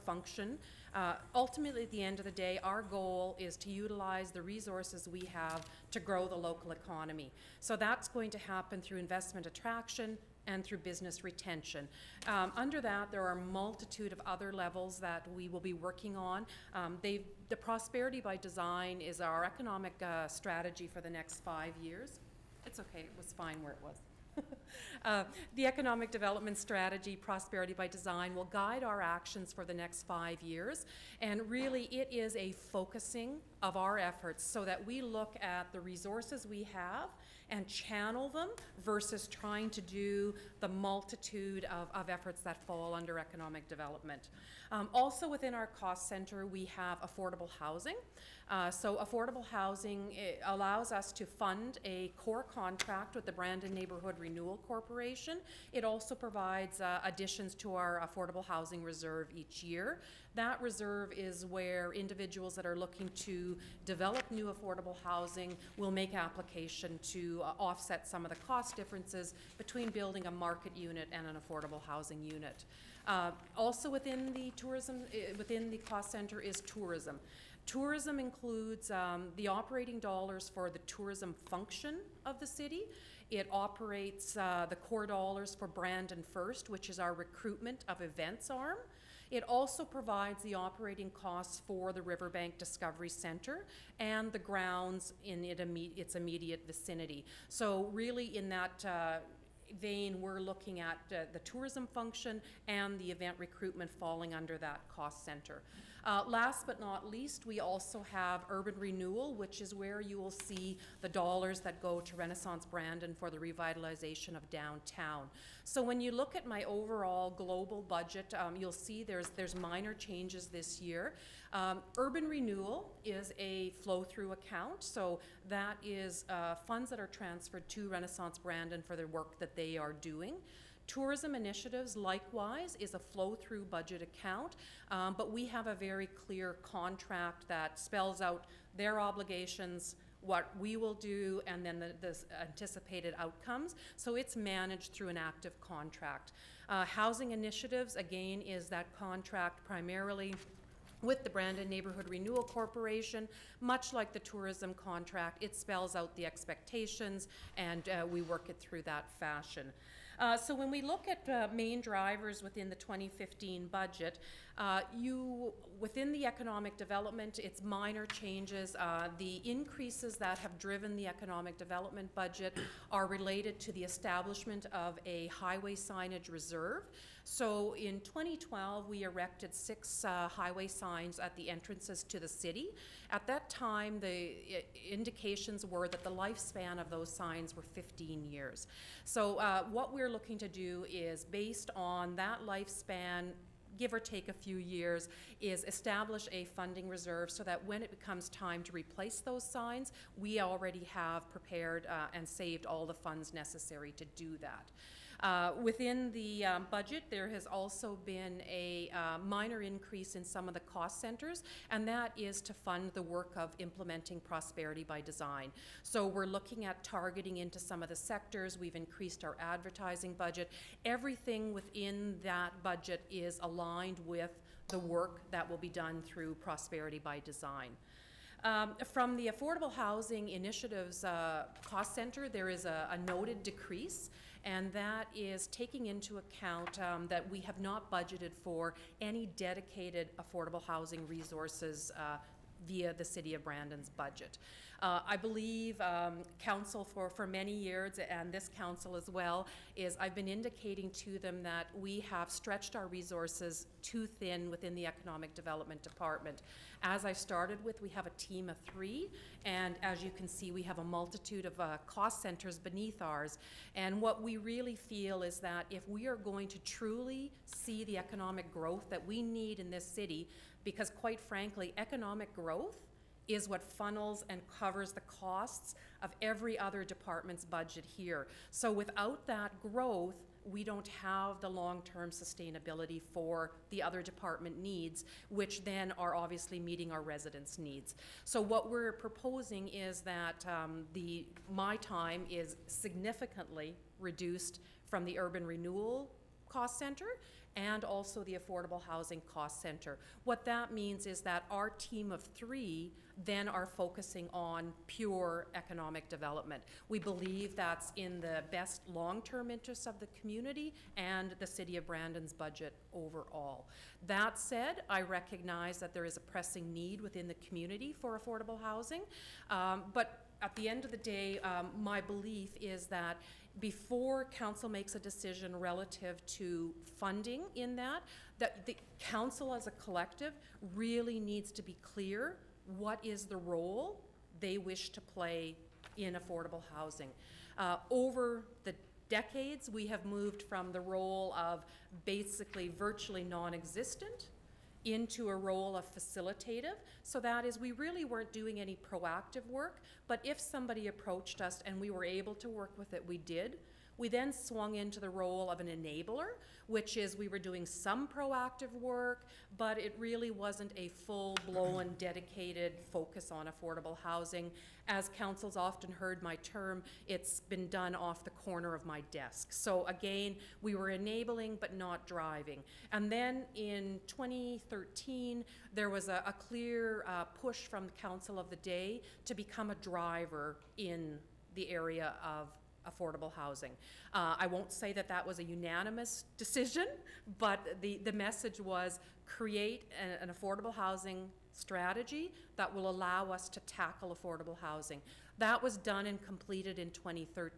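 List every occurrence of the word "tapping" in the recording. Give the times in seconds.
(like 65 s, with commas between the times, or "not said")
not said.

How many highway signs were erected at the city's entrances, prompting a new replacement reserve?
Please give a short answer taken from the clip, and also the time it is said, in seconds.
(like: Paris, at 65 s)
6, at 179 s.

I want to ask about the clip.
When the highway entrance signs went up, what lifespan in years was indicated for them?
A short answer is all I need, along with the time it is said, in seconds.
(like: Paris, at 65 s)
15, at 187 s.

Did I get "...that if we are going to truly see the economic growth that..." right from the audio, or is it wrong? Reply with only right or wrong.
right.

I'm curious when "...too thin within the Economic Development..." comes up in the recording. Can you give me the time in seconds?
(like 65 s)
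253 s.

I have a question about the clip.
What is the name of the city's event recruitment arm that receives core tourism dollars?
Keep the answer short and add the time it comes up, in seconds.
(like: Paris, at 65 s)
Brandon First, at 85 s.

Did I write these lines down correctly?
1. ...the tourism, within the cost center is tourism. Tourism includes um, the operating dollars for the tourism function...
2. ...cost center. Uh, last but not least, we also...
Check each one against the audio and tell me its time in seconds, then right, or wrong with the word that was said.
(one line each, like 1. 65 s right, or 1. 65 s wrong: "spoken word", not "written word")
1. 74 s right
2. 104 s right.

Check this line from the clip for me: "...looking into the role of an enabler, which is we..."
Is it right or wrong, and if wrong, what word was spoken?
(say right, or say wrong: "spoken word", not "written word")
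wrong: "swung", not "looking".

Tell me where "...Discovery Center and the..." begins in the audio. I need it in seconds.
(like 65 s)
92 s.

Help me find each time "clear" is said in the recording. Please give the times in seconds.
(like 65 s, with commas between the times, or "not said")
136 s, 331 s, 376 s.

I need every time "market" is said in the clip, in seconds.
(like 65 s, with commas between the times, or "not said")
70 s.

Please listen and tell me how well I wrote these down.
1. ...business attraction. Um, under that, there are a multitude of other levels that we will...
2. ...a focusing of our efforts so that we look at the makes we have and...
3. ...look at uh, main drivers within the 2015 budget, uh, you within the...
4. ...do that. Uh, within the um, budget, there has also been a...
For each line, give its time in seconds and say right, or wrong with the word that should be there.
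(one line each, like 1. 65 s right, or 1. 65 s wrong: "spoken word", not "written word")
1. 10 s wrong: "retention", not "attraction"
2. 32 s wrong: "resources", not "makes"
3. 160 s right
4. 204 s right.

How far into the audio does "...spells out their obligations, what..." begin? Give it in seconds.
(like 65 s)
137 s.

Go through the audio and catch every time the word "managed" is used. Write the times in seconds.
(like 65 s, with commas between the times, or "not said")
144 s.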